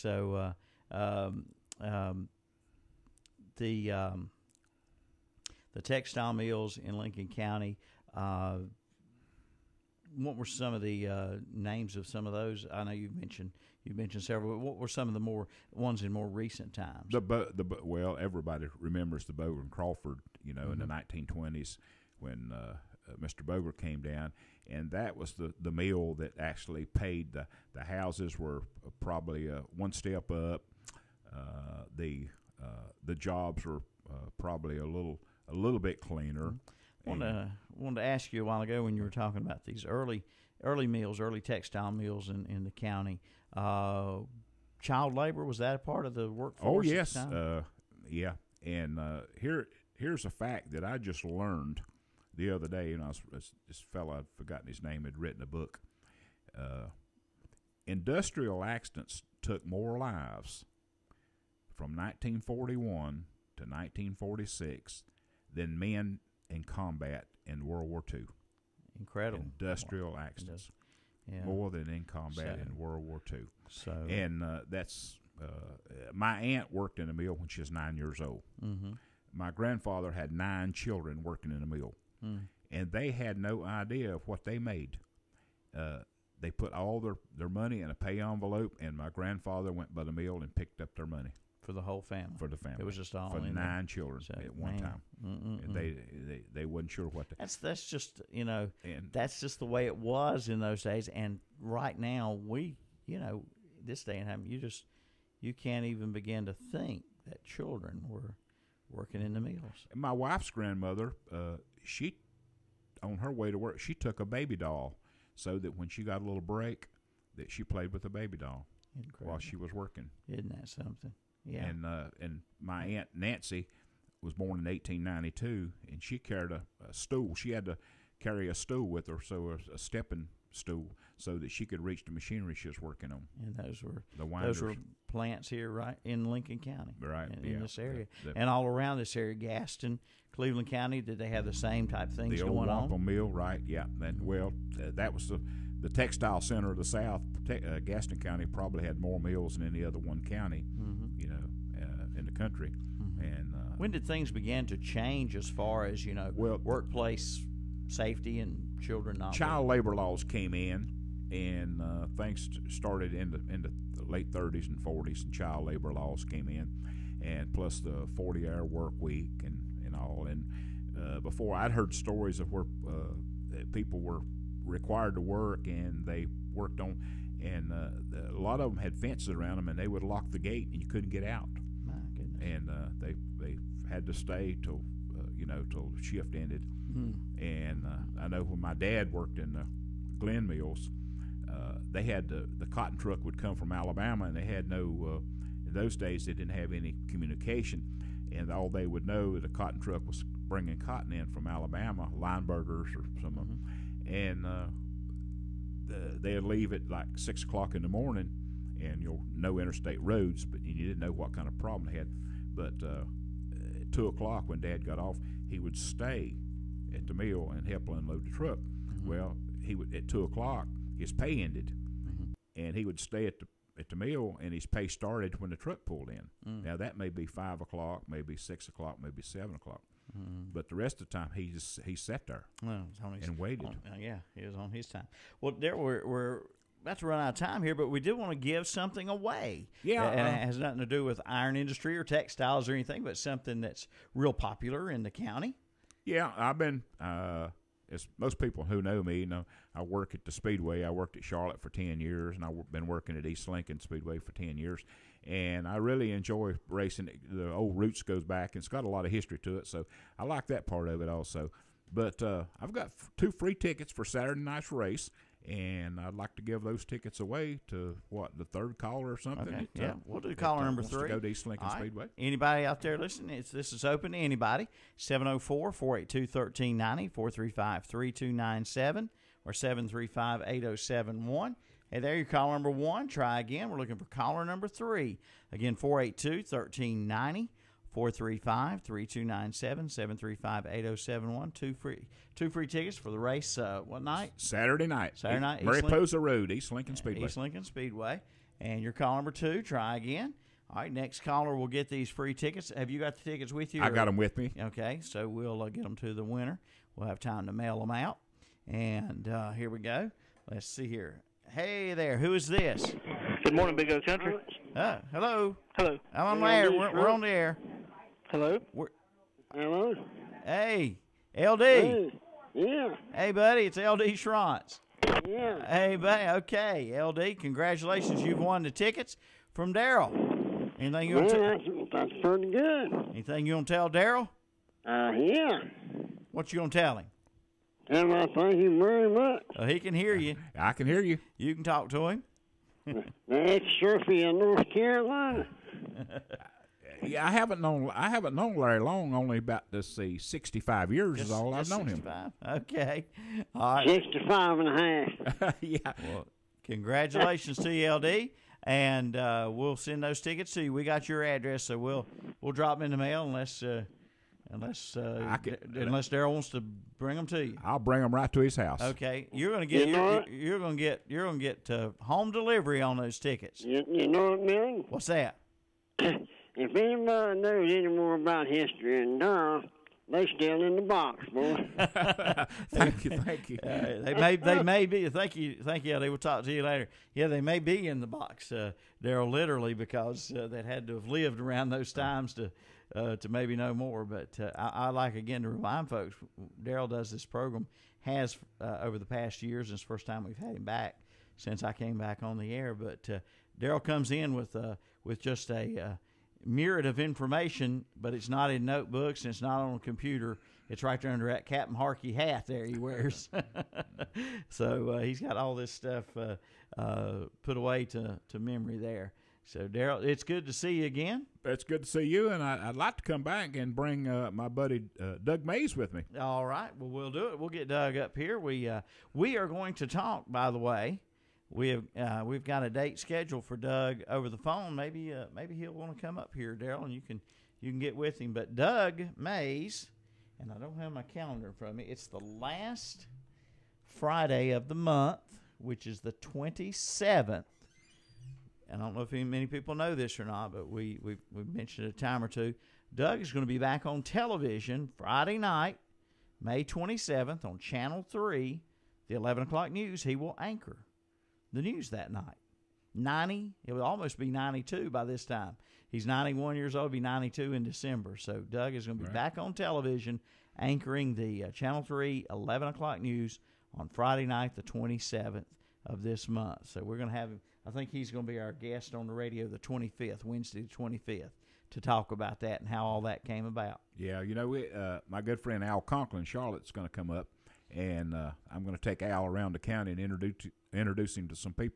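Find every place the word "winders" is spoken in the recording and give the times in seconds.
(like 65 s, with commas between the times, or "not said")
134 s.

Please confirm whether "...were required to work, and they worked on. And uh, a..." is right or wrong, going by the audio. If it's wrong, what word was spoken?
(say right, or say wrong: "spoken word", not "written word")
right.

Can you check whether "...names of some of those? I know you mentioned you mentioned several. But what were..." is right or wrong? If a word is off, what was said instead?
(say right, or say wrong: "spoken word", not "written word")
right.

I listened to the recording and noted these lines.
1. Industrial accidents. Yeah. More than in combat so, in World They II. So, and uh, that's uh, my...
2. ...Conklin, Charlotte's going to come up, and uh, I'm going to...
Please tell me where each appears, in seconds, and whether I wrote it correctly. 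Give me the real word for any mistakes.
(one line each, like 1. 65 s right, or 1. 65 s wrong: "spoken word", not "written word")
1. 69 s wrong: "War", not "They"
2. 485 s right.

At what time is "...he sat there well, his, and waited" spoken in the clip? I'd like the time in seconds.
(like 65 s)
231 s.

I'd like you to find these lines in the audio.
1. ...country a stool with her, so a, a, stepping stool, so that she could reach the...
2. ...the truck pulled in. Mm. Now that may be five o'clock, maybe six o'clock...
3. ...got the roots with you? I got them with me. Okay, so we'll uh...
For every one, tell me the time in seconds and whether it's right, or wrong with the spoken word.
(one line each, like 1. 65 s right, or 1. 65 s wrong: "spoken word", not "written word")
1. 128 s wrong: "carry", not "country"
2. 225 s right
3. 302 s wrong: "tickets", not "roots".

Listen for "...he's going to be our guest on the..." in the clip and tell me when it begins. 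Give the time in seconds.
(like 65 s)
477 s.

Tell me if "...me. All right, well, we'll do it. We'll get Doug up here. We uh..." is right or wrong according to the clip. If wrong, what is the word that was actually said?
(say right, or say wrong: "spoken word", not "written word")
right.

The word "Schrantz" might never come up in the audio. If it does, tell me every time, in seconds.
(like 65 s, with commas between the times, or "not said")
324 s.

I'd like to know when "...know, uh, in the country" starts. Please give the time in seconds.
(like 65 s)
151 s.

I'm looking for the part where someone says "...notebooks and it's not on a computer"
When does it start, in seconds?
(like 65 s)
408 s.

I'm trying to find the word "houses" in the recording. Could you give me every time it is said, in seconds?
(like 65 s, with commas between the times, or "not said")
27 s, 368 s.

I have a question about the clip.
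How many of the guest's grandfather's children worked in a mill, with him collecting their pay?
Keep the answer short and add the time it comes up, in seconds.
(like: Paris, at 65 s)
9, at 80 s.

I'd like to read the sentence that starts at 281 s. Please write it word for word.
Hey there, your caller number one.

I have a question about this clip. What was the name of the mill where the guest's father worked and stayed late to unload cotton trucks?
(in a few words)
Glen Mills.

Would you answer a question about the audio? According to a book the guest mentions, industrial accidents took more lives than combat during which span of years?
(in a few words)
1941 to 1946.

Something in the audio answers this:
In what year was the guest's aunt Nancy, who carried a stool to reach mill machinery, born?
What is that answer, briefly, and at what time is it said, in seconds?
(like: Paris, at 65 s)
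1892, at 124 s.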